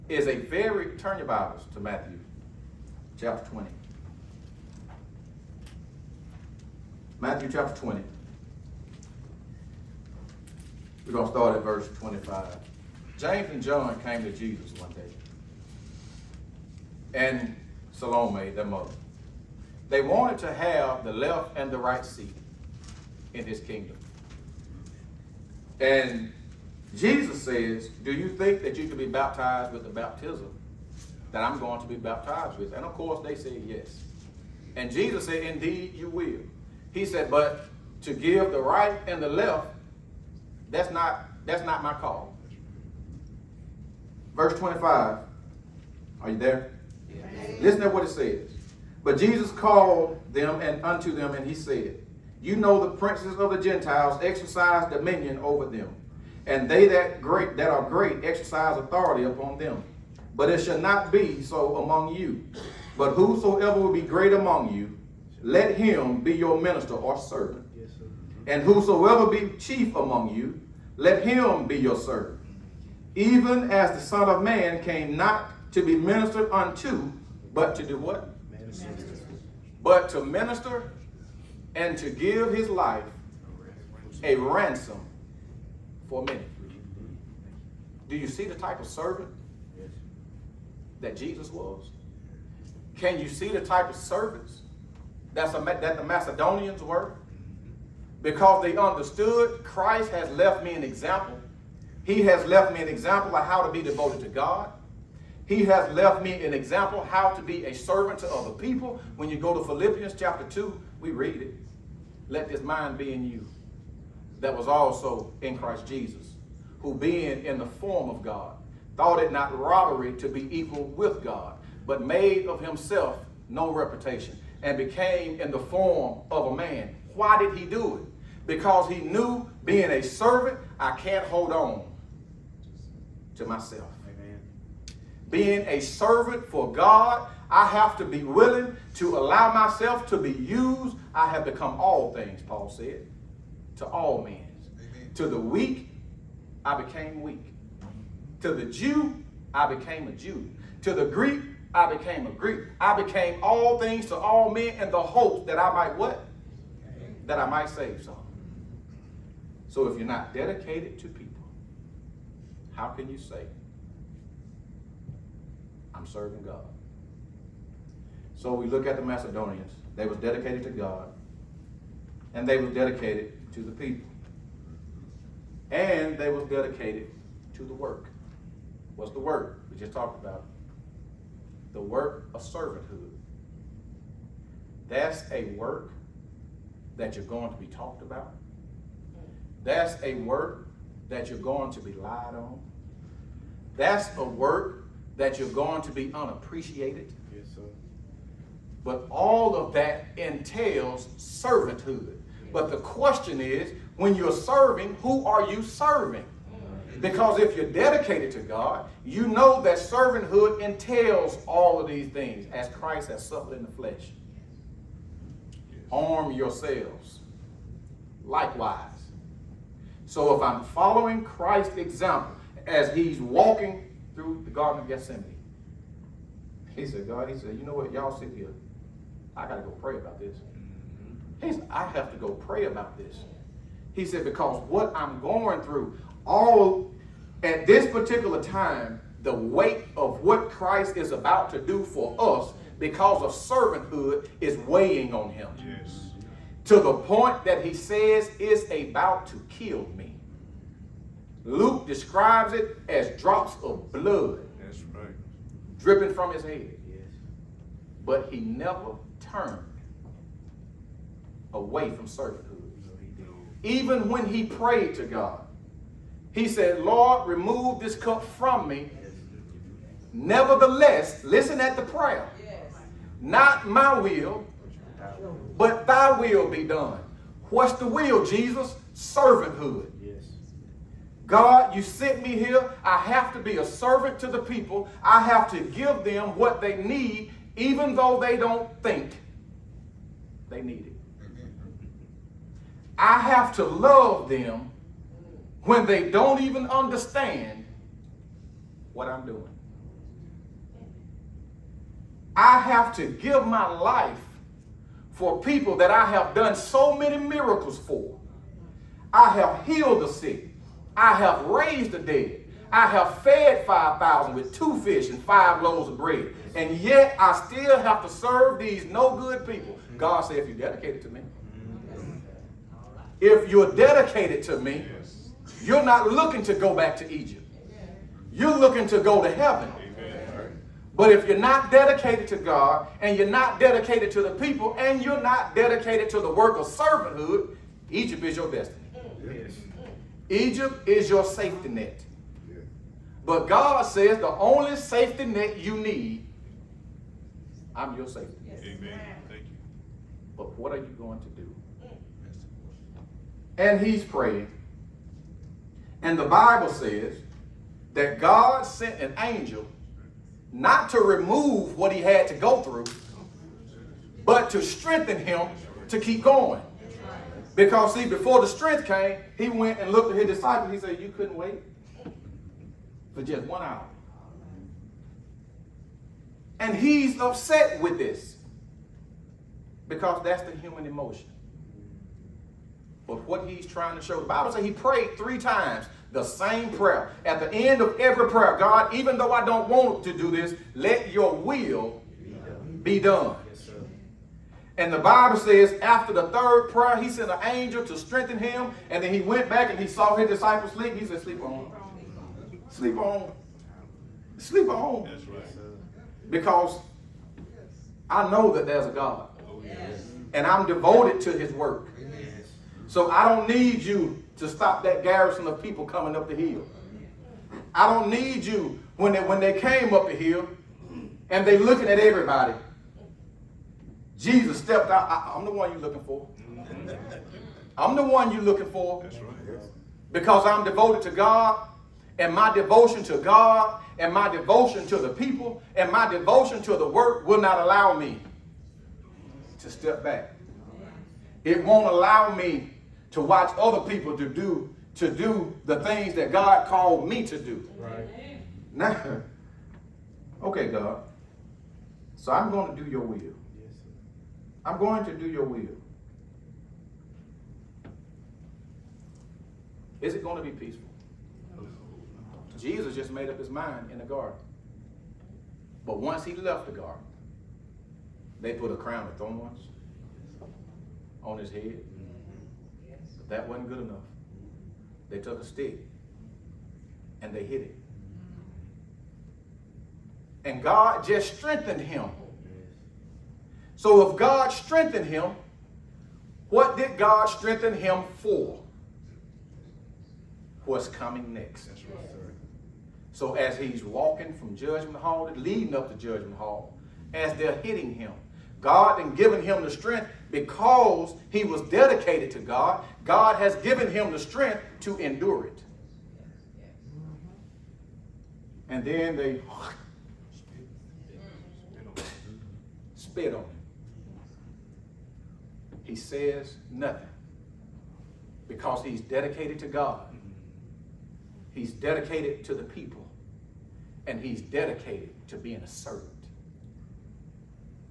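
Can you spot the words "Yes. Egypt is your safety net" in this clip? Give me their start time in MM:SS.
05:39.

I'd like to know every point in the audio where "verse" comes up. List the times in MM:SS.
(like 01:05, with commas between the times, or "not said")
00:11, 00:44.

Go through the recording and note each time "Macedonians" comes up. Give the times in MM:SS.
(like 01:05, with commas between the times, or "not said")
01:36, 02:49.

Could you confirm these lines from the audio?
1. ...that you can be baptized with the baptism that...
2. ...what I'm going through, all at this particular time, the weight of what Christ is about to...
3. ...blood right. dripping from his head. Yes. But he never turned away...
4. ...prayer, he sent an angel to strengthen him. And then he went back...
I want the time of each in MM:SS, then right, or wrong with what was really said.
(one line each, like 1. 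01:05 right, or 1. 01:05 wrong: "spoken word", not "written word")
1. 00:28 right
2. 03:54 right
3. 04:13 right
4. 06:36 right.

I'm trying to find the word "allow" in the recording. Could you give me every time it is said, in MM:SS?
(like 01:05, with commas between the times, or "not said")
02:19, 07:17, 07:21.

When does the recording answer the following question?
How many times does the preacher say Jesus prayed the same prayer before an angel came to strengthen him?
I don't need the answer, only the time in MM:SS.
06:25.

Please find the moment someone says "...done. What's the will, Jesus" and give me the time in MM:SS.
04:36.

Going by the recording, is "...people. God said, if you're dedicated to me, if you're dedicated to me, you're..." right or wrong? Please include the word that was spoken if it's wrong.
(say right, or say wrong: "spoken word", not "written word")
right.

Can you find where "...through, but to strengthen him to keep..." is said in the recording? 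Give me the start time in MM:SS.
06:02.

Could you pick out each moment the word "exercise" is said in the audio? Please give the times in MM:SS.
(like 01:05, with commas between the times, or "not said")
00:54, 00:58.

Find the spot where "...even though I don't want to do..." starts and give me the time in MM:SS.
06:28.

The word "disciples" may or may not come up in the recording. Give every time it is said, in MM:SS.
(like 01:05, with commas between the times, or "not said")
06:10, 06:40.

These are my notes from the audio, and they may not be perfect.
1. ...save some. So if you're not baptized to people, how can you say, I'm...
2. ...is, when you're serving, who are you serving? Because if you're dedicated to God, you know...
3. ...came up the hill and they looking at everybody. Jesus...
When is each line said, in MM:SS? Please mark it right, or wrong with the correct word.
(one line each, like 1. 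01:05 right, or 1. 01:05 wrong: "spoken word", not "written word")
1. 02:37 wrong: "dedicated", not "baptized"
2. 03:23 right
3. 06:59 right.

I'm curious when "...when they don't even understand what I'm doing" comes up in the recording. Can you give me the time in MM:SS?
04:55.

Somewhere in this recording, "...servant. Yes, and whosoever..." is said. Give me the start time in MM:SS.
01:07.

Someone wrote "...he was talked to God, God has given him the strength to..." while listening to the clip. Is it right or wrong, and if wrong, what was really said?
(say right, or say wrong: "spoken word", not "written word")
wrong: "dedicated", not "talked".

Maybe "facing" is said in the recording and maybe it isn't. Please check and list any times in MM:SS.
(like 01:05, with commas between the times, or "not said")
not said.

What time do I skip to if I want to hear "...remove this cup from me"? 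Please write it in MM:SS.
04:27.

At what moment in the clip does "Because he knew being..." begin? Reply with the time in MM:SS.
02:08.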